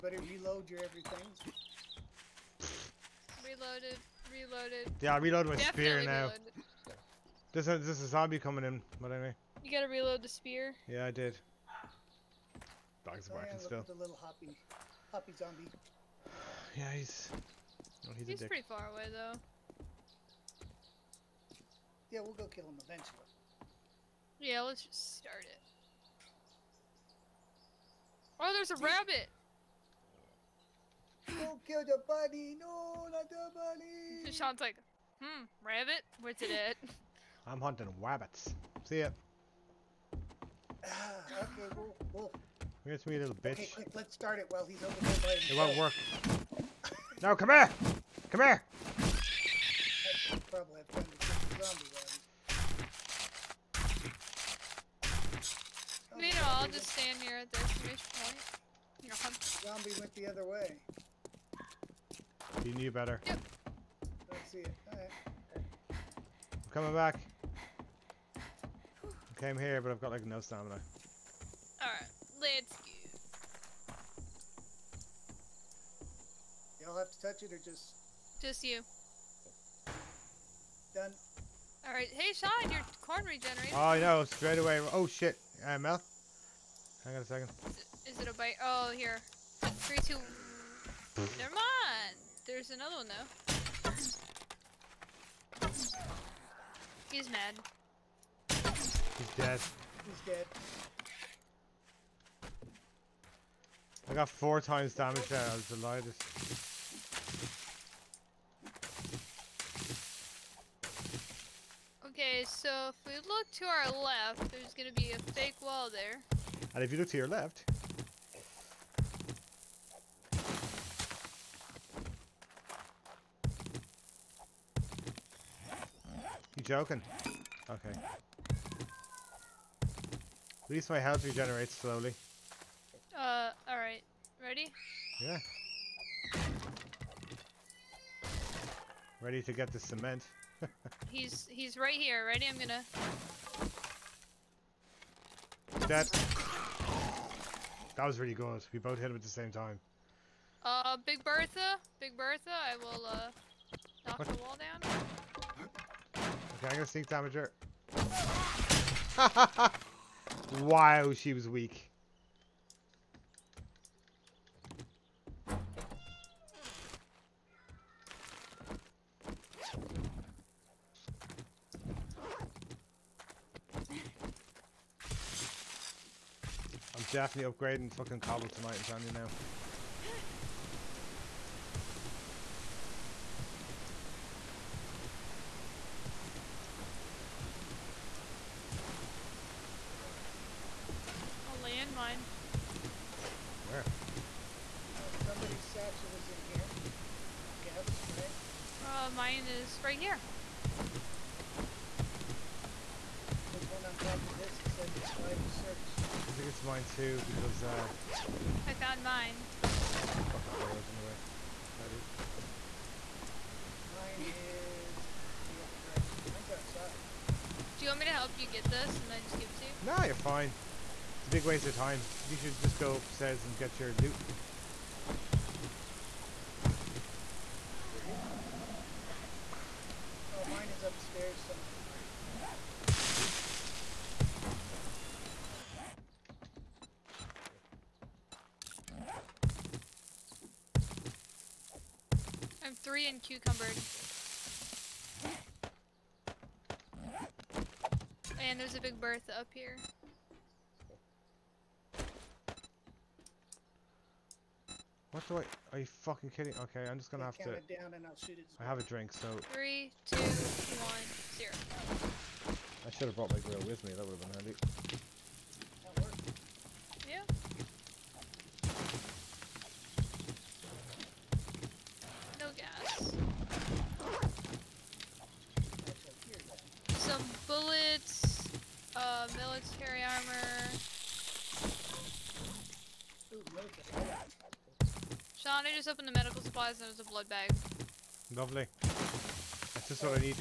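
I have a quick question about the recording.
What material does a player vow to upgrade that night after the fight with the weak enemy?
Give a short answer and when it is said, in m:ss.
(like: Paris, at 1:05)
Cobble, at 2:58.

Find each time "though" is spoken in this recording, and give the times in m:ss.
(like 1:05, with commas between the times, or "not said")
0:19, 1:35.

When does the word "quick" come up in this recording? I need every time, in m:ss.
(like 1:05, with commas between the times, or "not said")
0:43.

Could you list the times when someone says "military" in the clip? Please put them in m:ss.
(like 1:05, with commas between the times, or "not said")
4:39.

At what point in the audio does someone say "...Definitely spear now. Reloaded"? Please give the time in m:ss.
0:05.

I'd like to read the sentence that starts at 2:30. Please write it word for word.
Uh, Big Bertha, Big Bertha, I will uh knock the wall down.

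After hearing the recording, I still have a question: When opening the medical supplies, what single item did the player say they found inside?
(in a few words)
Blood bag.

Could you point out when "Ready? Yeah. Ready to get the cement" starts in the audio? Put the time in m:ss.
2:14.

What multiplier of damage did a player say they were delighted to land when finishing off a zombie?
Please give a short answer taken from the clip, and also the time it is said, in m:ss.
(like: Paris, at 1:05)
4, at 1:44.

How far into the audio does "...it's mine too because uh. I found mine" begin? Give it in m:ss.
3:26.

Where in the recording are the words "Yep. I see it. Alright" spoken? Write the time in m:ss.
1:03.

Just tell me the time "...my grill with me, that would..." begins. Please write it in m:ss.
4:23.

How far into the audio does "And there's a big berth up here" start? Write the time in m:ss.
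4:08.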